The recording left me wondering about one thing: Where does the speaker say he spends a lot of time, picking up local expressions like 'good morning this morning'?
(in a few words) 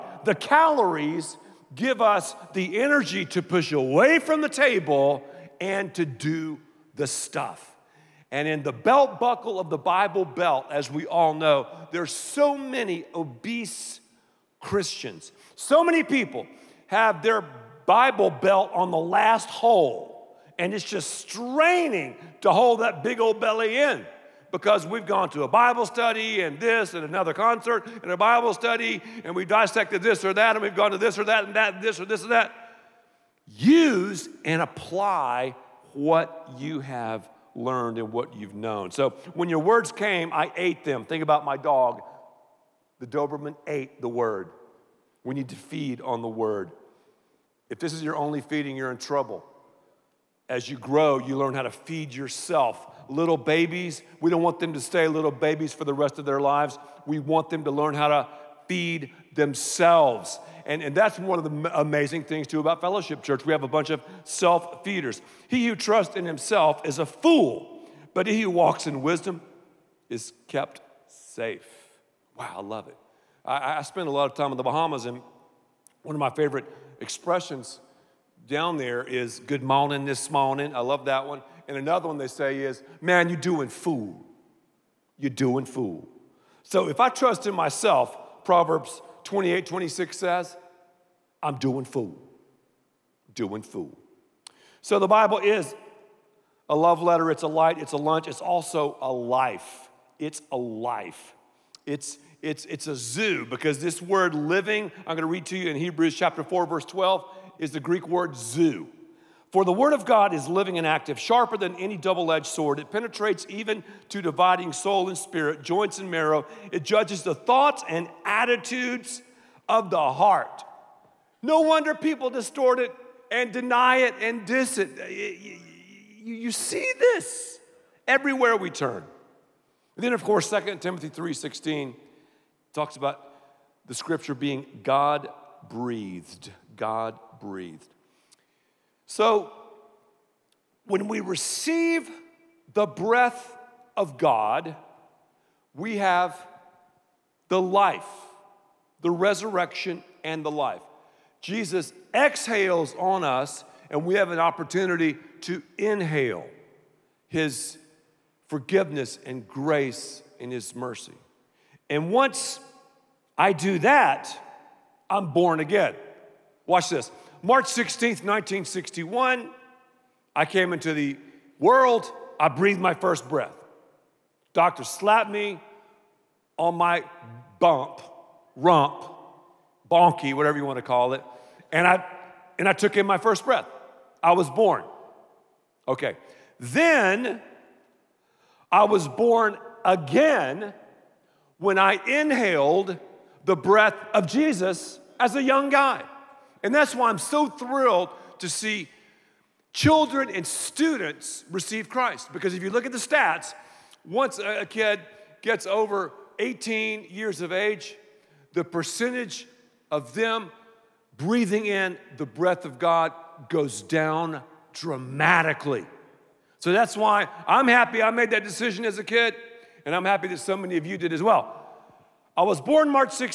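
The Bahamas.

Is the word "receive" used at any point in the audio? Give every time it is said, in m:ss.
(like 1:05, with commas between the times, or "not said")
2:21, 3:21.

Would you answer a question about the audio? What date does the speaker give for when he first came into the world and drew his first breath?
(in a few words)
March 16, 1961.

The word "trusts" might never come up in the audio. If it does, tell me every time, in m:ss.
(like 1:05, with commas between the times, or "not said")
1:05, 1:27.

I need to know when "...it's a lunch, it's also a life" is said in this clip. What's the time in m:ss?
1:37.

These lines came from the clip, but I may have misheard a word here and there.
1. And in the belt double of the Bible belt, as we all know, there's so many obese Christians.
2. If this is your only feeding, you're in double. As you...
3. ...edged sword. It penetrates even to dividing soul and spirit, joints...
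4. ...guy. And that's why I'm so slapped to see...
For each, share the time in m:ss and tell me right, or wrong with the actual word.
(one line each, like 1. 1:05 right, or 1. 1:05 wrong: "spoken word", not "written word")
1. 0:08 wrong: "buckle", not "double"
2. 0:47 wrong: "trouble", not "double"
3. 1:52 right
4. 3:15 wrong: "thrilled", not "slapped".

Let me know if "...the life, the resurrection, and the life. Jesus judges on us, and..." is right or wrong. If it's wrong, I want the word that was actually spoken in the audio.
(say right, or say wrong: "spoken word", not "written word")
wrong: "exhales", not "judges".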